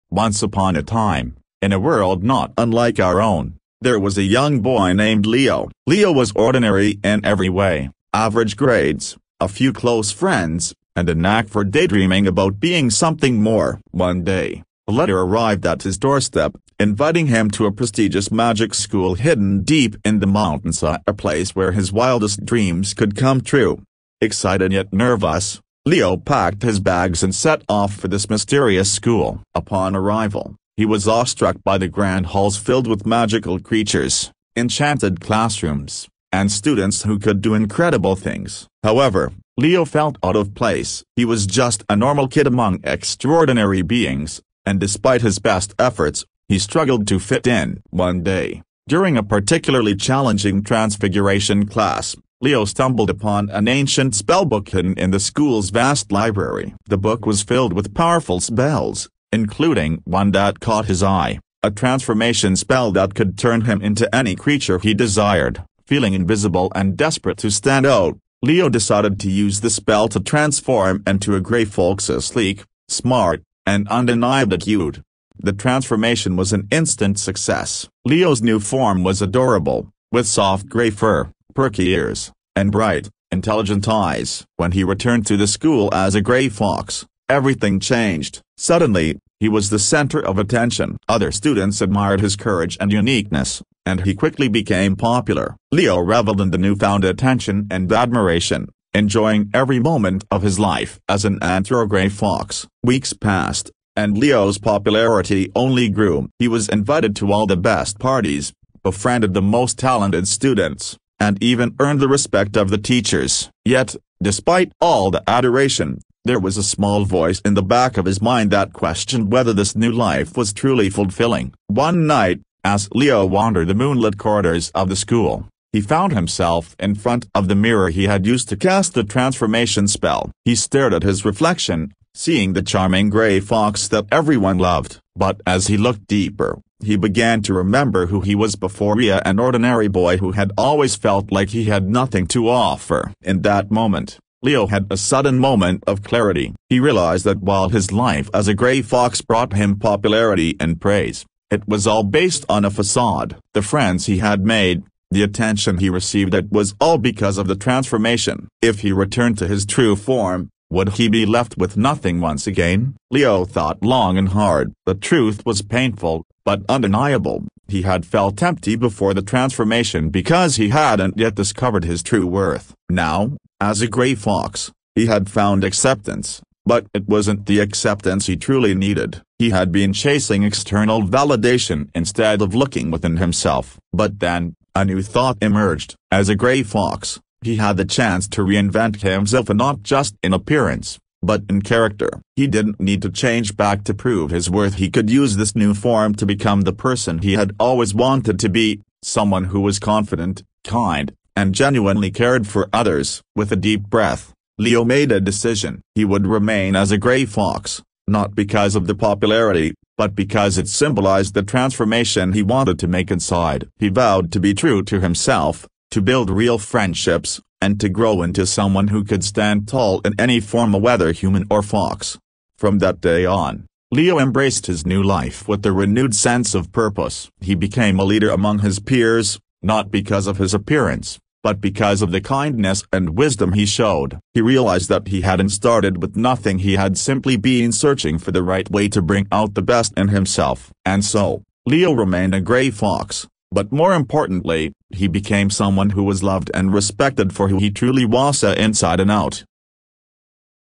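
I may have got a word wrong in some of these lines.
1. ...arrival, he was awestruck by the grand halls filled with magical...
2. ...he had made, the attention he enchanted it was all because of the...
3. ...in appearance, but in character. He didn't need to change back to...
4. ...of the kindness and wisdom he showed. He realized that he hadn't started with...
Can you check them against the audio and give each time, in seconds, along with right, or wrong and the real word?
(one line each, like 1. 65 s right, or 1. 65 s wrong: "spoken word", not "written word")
1. 29 s right
2. 154 s wrong: "received", not "enchanted"
3. 190 s right
4. 232 s right.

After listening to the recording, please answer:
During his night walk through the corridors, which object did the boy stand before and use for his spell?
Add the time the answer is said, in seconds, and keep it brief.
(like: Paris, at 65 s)
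The mirror, at 127 s.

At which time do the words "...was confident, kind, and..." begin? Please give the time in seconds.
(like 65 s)
199 s.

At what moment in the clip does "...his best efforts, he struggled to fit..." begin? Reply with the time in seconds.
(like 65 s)
45 s.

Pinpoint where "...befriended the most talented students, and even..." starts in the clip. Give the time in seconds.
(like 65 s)
108 s.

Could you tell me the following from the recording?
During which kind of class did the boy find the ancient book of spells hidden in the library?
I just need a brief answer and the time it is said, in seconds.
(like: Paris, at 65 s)
Transfiguration, at 50 s.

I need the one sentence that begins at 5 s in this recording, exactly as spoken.
Leo was ordinary in every way, average grades, a few close friends, and a knack for daydreaming about being something more.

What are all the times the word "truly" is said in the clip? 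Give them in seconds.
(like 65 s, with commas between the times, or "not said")
120 s, 178 s, 247 s.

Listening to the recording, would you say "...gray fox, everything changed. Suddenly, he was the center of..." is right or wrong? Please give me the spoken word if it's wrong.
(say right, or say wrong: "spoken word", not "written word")
right.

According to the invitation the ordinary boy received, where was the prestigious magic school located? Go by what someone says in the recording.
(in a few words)
Deep in the mountains.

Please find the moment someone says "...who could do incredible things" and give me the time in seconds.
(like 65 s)
37 s.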